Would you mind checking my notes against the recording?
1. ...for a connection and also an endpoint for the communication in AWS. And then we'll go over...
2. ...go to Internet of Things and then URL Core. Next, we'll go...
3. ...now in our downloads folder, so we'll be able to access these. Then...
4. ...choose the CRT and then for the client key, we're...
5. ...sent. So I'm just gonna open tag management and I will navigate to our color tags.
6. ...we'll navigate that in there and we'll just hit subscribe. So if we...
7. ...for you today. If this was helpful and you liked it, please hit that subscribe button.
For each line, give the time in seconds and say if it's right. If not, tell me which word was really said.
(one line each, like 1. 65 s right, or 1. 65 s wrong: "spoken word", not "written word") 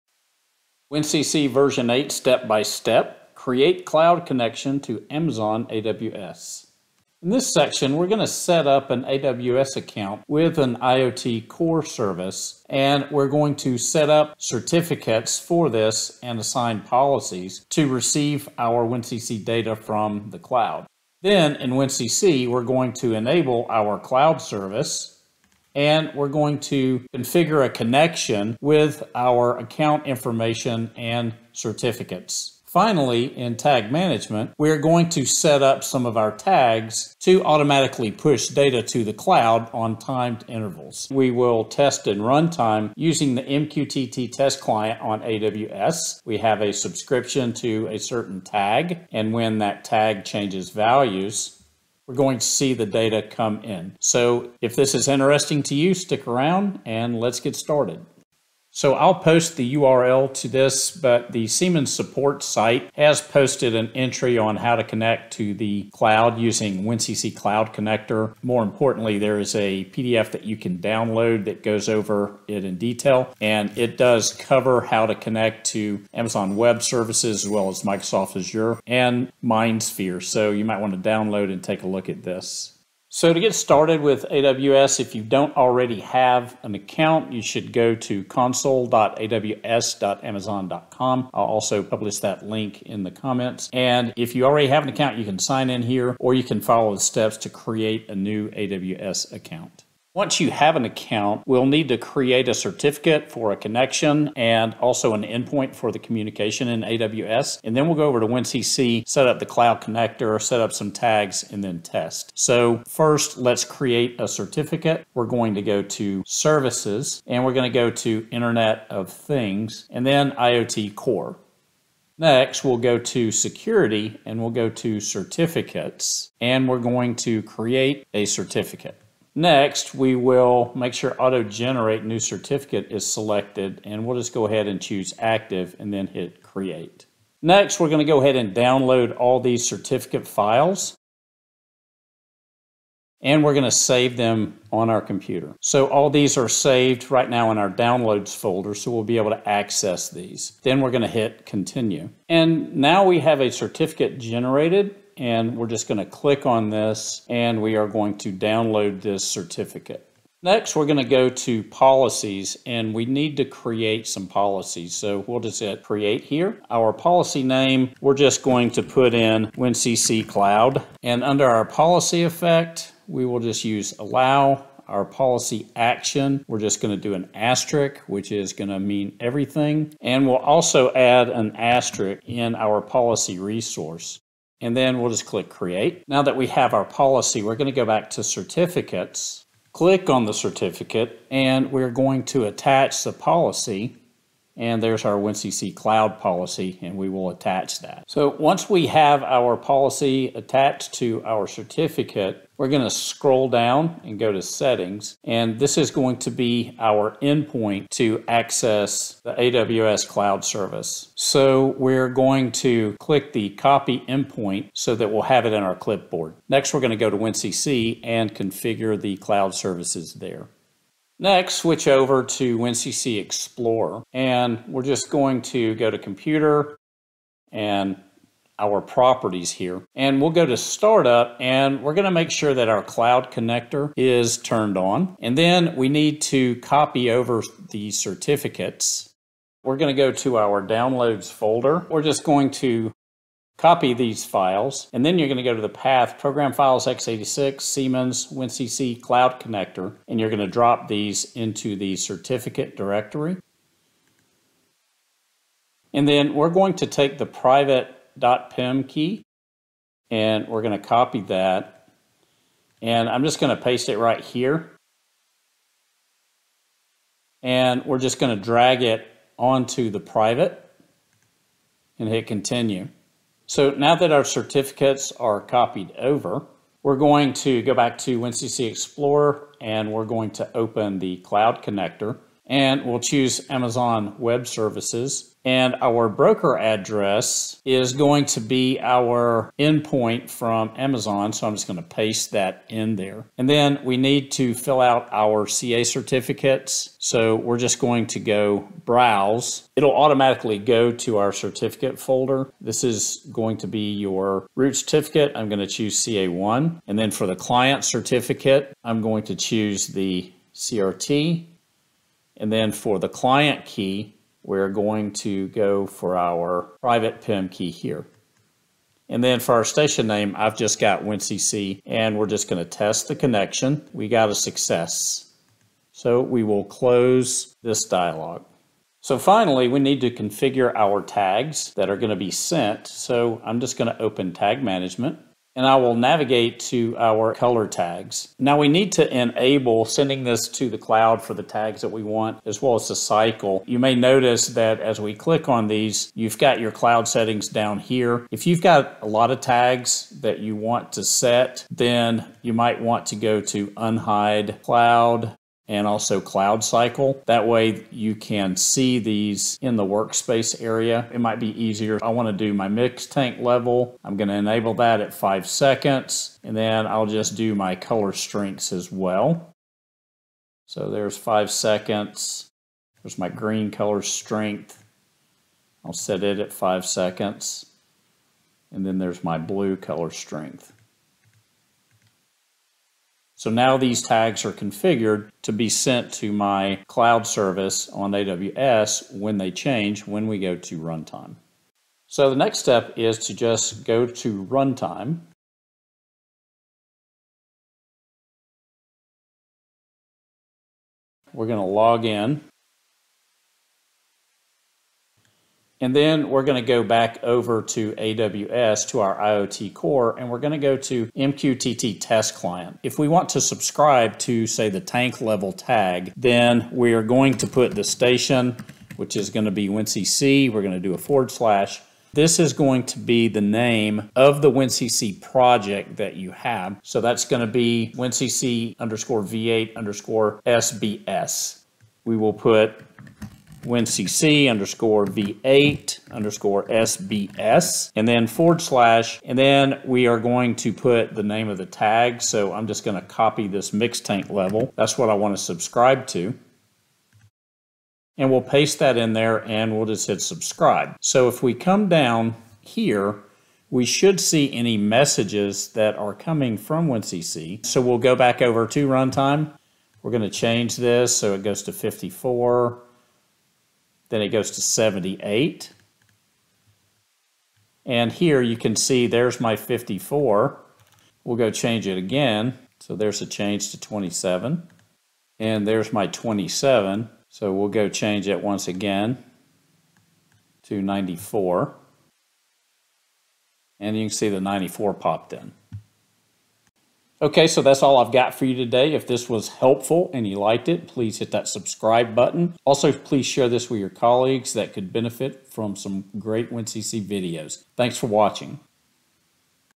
1. 103 s right
2. 117 s wrong: "IoT", not "URL"
3. 147 s right
4. 309 s right
5. 332 s right
6. 448 s wrong: "paste", not "navigate"
7. 488 s right.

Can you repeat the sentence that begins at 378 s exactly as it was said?
And then there's my blue color strength.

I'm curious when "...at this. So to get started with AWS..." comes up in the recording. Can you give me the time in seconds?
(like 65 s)
82 s.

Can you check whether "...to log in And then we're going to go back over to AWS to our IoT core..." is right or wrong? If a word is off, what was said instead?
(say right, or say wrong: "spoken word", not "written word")
right.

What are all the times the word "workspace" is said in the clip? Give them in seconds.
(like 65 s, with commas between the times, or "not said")
359 s.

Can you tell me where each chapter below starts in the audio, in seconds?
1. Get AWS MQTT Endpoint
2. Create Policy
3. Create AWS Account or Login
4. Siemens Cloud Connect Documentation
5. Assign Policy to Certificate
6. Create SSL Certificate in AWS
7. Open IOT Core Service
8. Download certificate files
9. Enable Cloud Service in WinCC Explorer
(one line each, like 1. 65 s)
1. 199 s
2. 161 s
3. 85 s
4. 60 s
5. 186 s
6. 124 s
7. 101 s
8. 140 s
9. 222 s.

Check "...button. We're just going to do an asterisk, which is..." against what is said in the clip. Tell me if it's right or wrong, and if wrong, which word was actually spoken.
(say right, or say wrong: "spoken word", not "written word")
wrong: "action", not "button".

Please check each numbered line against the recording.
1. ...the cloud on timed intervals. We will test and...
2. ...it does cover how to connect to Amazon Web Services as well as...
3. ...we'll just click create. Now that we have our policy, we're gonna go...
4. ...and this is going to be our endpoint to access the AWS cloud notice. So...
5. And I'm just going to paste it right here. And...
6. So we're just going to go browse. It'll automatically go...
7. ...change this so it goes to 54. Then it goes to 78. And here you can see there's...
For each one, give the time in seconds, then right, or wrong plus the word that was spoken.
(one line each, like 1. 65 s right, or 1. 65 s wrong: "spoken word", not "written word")
1. 39 s right
2. 73 s right
3. 185 s right
4. 205 s wrong: "service", not "notice"
5. 262 s right
6. 296 s right
7. 460 s right.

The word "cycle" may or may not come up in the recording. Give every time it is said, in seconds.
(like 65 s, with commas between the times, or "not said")
342 s, 356 s.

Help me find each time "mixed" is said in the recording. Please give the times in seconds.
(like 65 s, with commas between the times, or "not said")
443 s.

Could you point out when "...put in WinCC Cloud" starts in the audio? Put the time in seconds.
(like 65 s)
168 s.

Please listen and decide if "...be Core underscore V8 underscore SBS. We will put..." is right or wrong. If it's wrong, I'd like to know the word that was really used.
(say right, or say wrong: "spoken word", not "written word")
wrong: "WinCC", not "Core".